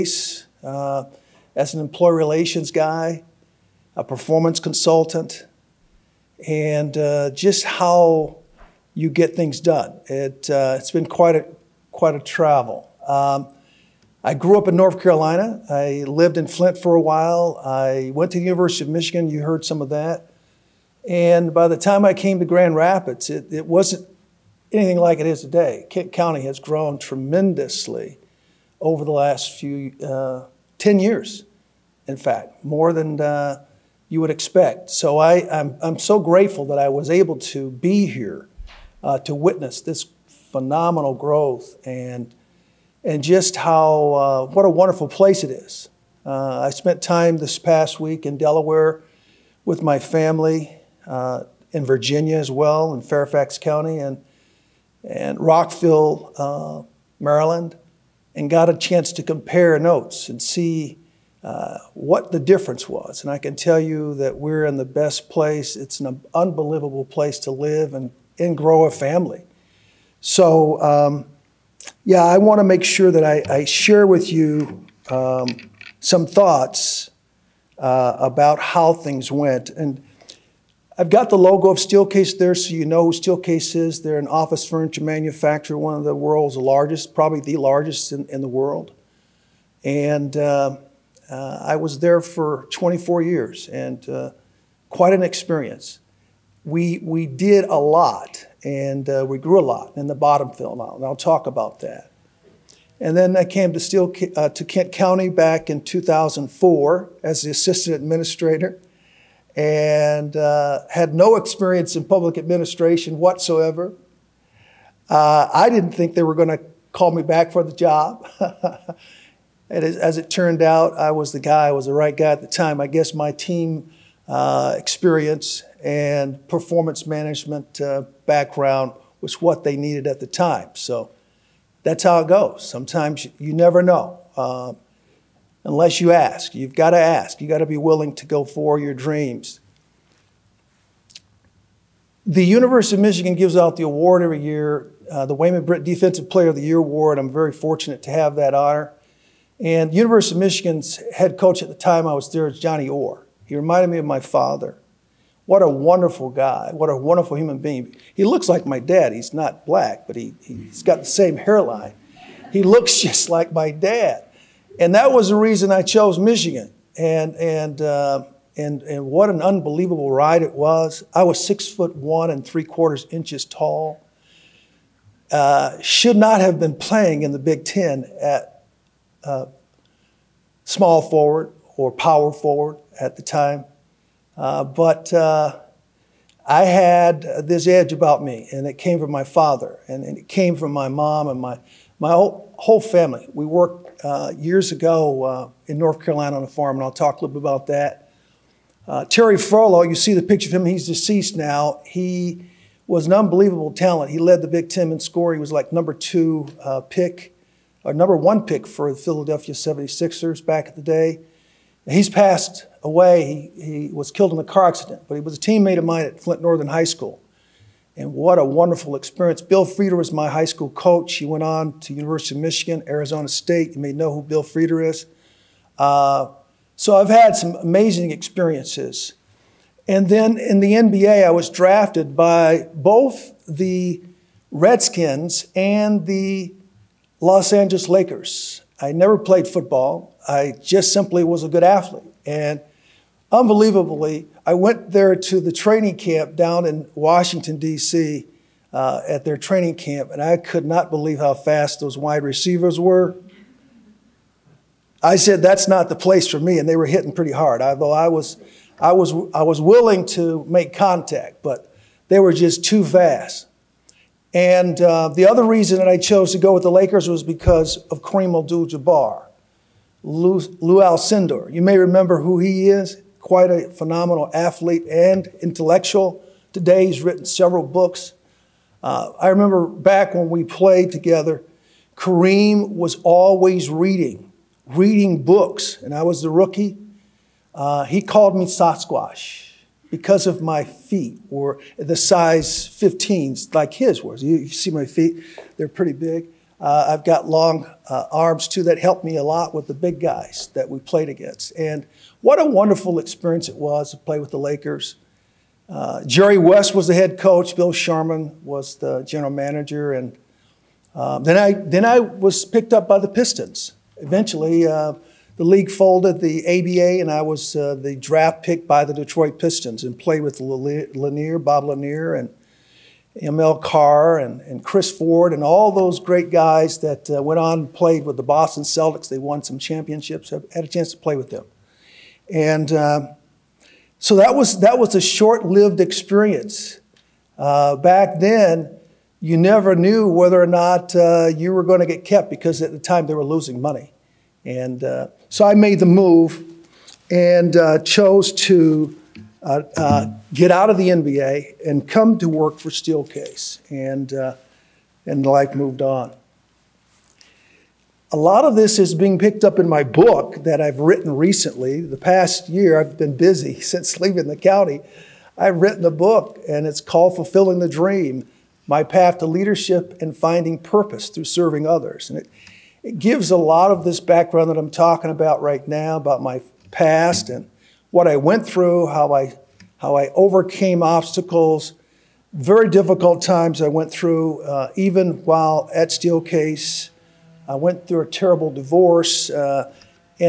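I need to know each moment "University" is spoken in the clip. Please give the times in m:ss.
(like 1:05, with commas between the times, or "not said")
0:18, 2:22, 2:29, 3:41.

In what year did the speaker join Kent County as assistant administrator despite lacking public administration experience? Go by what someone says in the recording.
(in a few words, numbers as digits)
2004.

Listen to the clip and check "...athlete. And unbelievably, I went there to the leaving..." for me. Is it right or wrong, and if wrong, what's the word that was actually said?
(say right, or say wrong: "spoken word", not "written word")
wrong: "training", not "leaving".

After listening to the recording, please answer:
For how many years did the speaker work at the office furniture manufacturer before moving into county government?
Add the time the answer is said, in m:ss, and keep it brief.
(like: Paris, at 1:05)
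24 years, at 1:32.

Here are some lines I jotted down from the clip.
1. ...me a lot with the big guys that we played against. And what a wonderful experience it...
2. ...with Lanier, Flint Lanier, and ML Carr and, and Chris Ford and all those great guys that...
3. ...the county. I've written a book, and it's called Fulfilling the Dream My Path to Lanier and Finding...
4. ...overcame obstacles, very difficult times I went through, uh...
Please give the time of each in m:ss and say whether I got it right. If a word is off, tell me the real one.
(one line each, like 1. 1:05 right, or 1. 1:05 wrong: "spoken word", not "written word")
1. 4:59 right
2. 5:20 wrong: "Bob", not "Flint"
3. 6:04 wrong: "Leadership", not "Lanier"
4. 6:20 right.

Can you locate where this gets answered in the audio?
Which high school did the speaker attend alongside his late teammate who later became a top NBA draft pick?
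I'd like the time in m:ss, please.
3:36.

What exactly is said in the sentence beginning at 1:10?
So, um, yeah, I want to make sure that I, I share with you um, some thoughts uh, about how things went.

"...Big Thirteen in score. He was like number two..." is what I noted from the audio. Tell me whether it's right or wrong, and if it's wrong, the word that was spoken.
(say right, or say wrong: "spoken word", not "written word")
wrong: "Ten", not "Thirteen".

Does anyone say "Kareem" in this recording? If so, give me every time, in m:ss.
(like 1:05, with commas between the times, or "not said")
4:28, 4:41.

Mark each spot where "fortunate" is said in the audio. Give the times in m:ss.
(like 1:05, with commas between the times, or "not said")
2:27.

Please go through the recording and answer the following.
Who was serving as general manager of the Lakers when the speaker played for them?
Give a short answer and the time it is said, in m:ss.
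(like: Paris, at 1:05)
Bill Sharman, at 5:07.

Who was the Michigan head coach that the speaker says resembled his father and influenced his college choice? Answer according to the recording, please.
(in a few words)
Johnny Orr.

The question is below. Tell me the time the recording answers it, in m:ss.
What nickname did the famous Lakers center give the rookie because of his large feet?
4:48.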